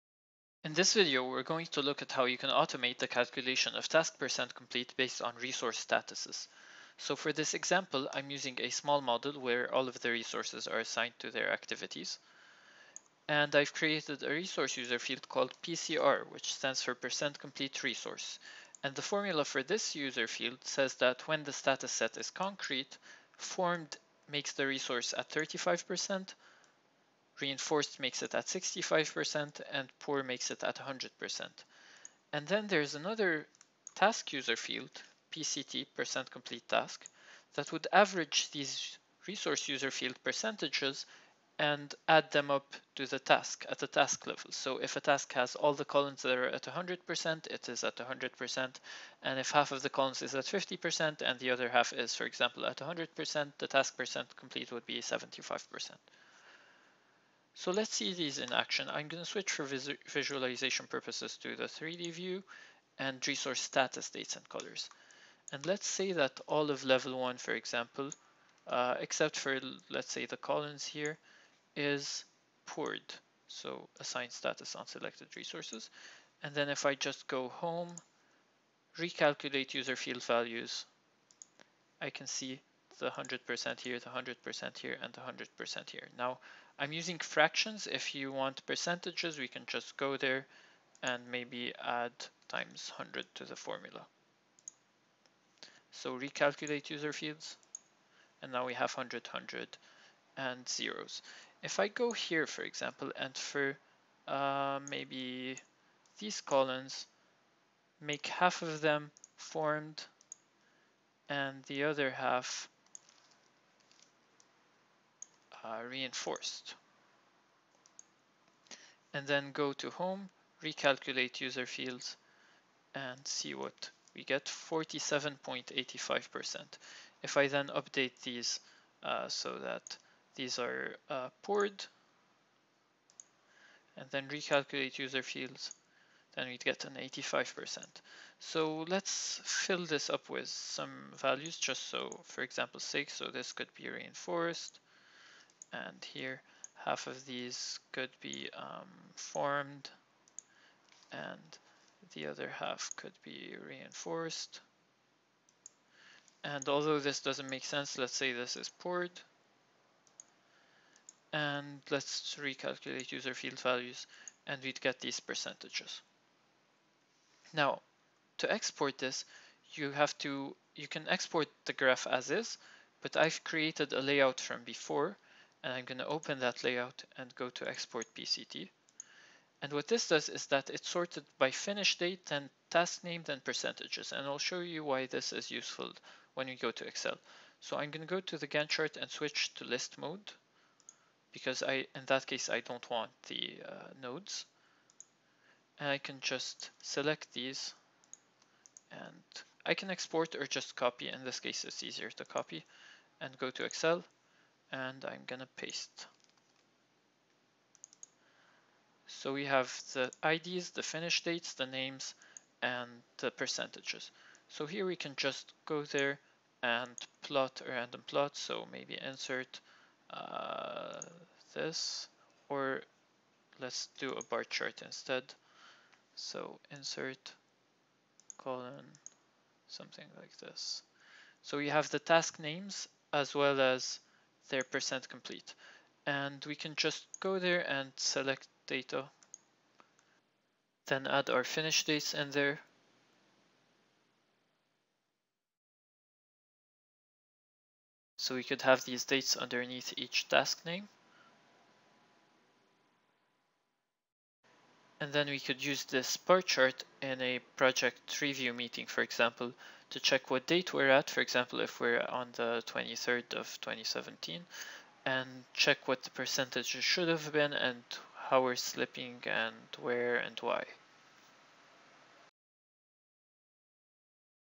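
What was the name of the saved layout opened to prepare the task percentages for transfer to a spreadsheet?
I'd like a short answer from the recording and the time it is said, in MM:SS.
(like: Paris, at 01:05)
export PCT, at 02:57.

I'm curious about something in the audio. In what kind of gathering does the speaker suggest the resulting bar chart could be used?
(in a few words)
project review meeting.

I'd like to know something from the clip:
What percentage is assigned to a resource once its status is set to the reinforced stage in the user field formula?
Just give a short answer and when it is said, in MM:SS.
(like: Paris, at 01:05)
65%, at 00:28.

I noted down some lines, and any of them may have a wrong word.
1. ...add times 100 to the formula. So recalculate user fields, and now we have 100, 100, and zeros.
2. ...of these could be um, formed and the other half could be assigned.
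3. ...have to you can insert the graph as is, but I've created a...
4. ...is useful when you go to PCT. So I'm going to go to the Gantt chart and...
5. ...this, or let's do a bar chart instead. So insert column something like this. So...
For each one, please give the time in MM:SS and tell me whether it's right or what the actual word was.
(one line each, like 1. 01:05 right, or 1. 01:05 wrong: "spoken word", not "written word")
1. 01:31 right
2. 02:27 wrong: "reinforced", not "assigned"
3. 02:49 wrong: "export", not "insert"
4. 03:05 wrong: "Excel", not "PCT"
5. 03:41 right.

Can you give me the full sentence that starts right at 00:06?
So for this example, I'm using a small model where all of the resources are assigned to their activities.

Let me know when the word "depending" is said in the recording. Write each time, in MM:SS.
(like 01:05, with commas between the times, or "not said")
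not said.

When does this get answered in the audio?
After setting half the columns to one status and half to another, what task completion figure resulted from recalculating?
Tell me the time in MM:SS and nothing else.
02:04.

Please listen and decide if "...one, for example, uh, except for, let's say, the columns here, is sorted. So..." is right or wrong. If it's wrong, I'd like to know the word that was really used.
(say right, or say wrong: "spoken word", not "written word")
wrong: "poured", not "sorted".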